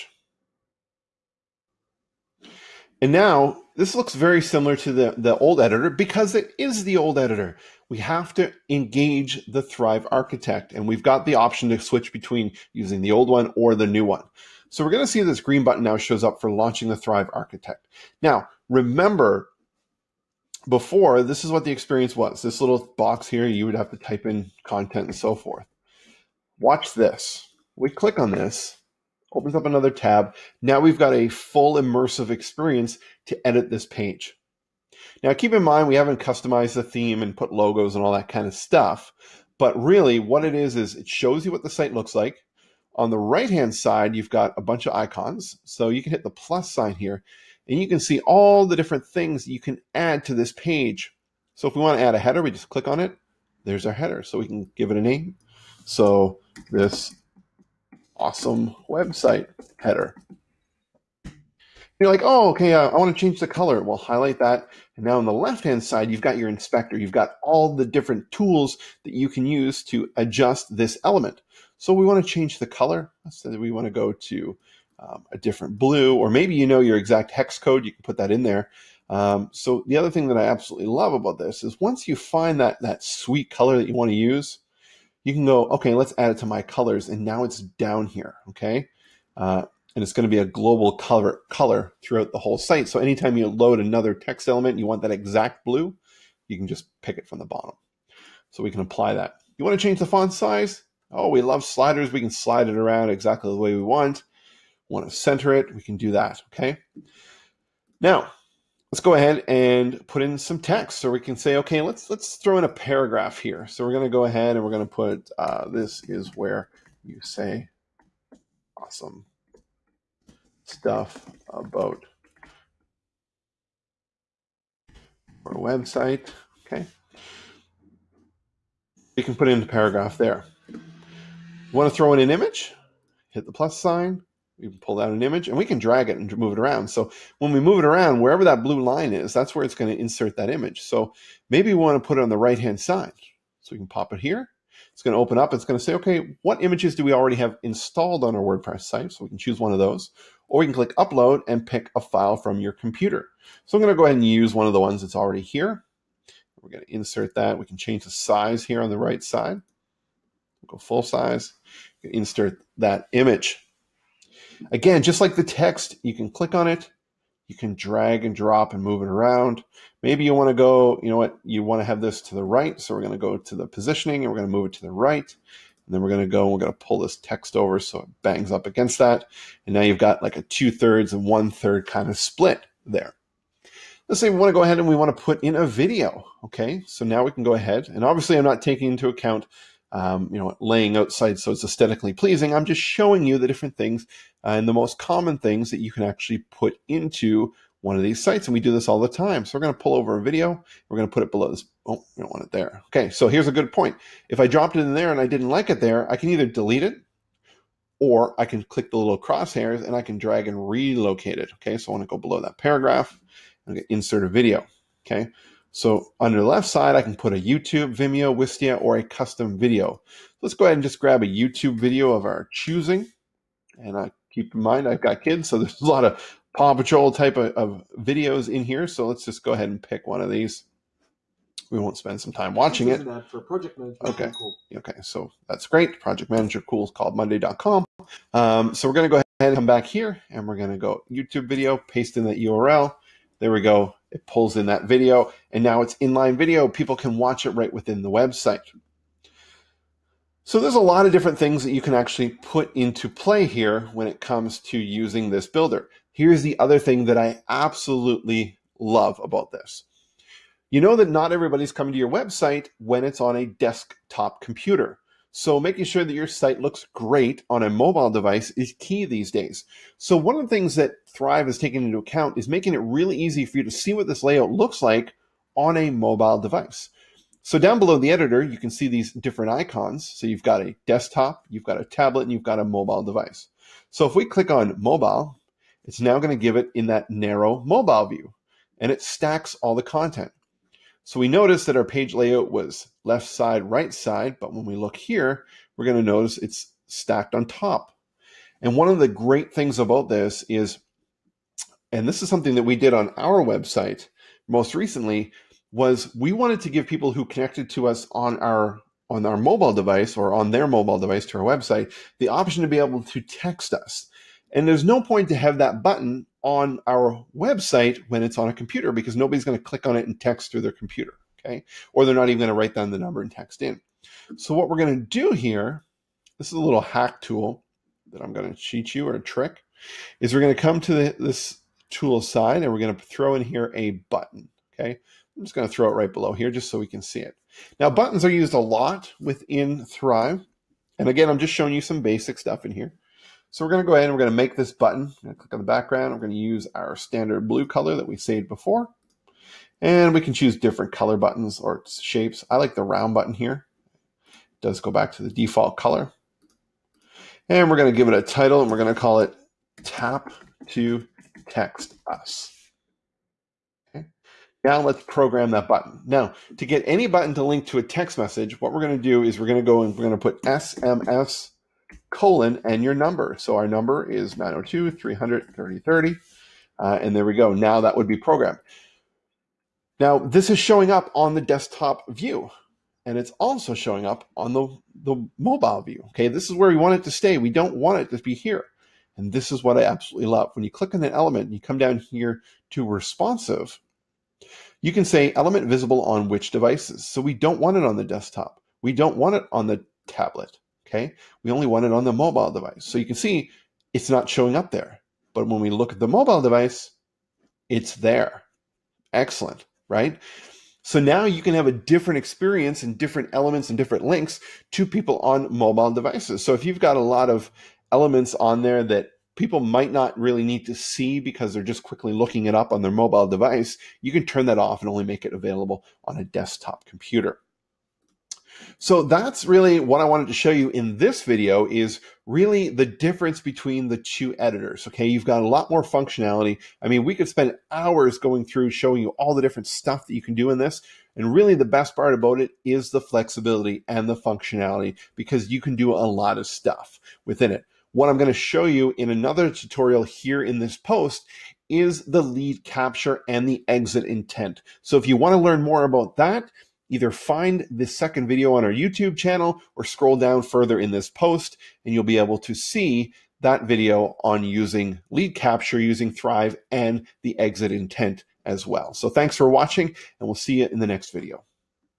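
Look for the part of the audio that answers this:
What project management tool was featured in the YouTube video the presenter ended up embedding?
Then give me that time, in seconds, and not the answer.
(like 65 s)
237 s.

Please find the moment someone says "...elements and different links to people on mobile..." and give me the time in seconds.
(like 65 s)
413 s.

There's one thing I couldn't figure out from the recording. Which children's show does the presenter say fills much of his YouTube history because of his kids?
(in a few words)
Paw Patrol.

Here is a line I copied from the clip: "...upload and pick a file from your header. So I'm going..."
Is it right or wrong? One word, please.
wrong.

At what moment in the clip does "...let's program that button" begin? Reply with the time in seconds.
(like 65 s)
364 s.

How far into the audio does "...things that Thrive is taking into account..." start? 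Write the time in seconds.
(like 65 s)
270 s.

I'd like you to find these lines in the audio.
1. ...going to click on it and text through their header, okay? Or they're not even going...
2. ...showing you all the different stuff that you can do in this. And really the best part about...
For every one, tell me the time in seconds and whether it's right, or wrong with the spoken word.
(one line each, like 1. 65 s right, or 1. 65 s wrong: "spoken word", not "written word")
1. 319 s wrong: "computer", not "header"
2. 438 s right.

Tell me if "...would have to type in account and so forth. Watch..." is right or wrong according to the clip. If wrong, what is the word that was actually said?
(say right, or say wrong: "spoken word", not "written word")
wrong: "content", not "account".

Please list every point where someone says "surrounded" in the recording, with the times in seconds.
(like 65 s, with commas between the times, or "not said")
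not said.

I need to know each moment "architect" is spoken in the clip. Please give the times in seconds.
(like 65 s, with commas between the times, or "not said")
10 s, 17 s.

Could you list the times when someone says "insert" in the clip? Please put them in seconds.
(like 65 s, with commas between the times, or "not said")
140 s, 156 s, 162 s, 213 s.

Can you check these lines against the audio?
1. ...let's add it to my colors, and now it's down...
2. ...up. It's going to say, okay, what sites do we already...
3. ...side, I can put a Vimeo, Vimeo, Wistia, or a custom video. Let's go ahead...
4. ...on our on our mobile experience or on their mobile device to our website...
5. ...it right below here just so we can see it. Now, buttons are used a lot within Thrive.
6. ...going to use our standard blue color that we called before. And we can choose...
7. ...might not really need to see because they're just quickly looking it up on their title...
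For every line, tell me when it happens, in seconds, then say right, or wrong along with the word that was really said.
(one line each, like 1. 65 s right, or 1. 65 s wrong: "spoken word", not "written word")
1. 85 s right
2. 145 s wrong: "images", not "sites"
3. 216 s wrong: "YouTube", not "Vimeo"
4. 308 s wrong: "device", not "experience"
5. 335 s right
6. 346 s wrong: "saved", not "called"
7. 419 s wrong: "mobile", not "title".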